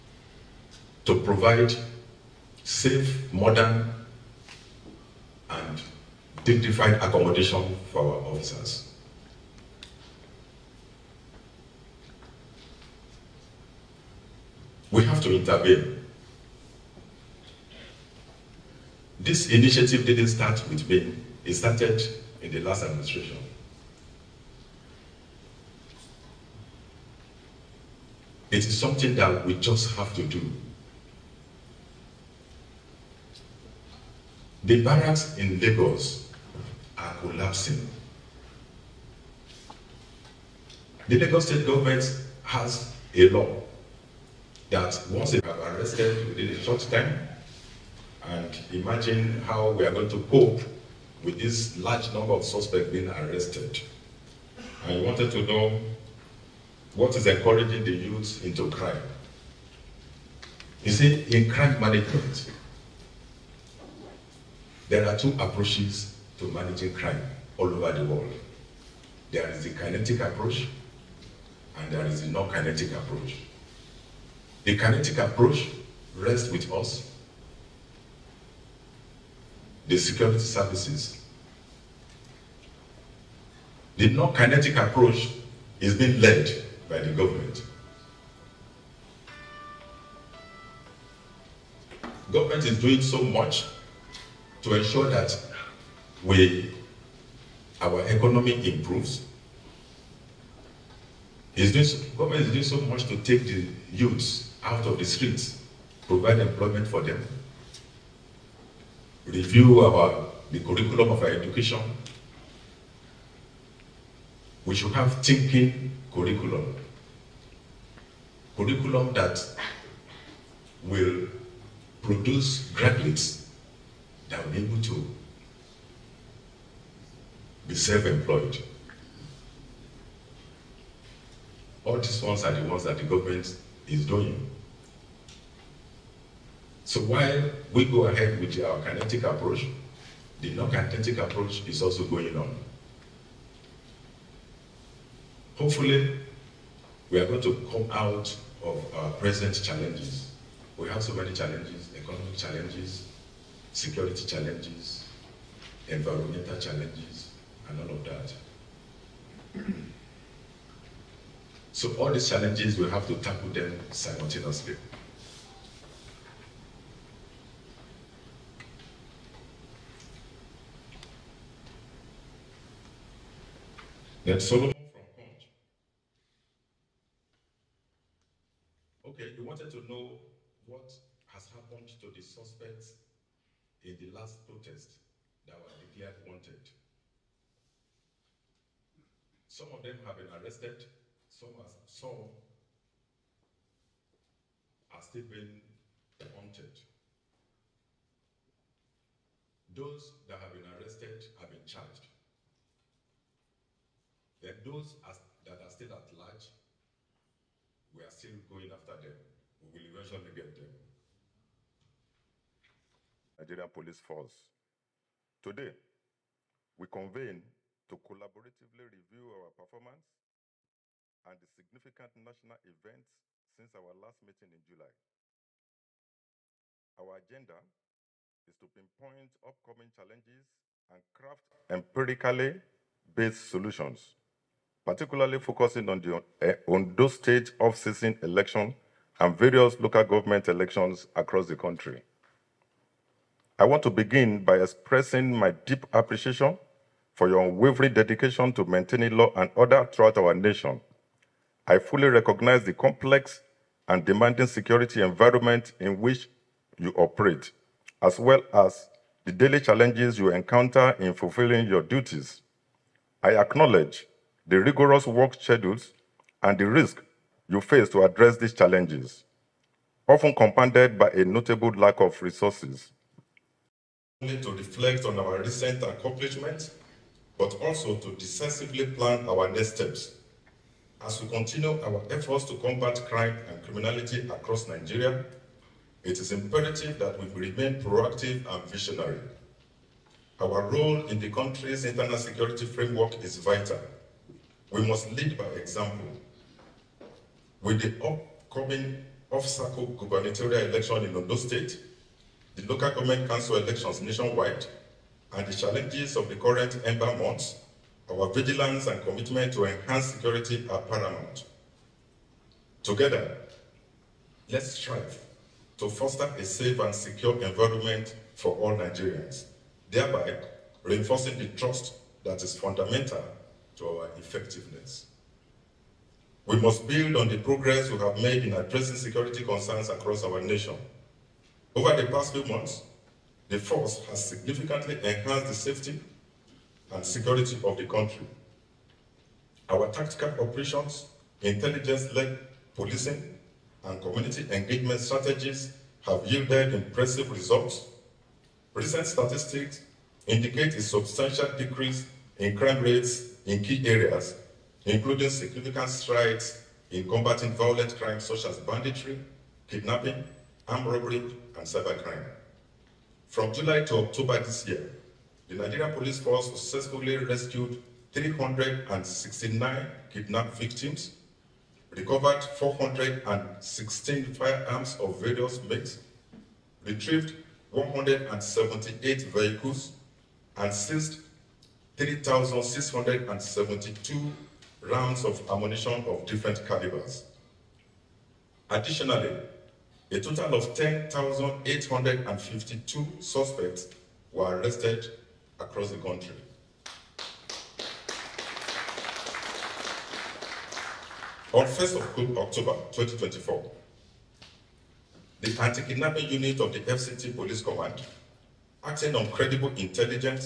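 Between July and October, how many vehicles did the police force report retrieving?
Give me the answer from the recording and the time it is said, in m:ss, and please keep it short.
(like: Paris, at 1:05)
178, at 6:17.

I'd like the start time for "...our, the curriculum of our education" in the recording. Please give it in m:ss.
1:49.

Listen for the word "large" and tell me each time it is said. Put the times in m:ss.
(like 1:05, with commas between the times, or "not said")
0:51, 3:26.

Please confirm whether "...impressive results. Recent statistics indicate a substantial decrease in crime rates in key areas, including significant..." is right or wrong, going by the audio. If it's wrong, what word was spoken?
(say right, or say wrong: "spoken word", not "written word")
right.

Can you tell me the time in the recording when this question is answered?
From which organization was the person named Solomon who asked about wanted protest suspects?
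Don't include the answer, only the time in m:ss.
2:55.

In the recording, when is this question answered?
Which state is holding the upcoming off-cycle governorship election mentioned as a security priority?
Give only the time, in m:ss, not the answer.
5:01.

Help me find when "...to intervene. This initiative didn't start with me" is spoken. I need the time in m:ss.
0:15.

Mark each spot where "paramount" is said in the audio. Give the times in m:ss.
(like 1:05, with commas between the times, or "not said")
5:10.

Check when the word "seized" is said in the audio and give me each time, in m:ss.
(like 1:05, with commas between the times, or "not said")
6:20.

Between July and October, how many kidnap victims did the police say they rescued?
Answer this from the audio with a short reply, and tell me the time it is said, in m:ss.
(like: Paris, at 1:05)
369, at 6:08.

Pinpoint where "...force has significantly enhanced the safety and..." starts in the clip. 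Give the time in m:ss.
5:33.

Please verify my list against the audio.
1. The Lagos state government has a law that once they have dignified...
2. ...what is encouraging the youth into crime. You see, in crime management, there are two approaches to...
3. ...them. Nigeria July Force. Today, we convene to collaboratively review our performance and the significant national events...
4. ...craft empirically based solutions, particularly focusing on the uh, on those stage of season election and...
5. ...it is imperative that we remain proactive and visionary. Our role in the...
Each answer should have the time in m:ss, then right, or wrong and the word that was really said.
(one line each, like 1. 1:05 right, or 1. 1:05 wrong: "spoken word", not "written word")
1. 0:41 wrong: "arrested", not "dignified"
2. 0:56 right
3. 3:30 wrong: "Police", not "July"
4. 3:51 right
5. 4:46 right.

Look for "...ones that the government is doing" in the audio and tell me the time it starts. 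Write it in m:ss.
2:12.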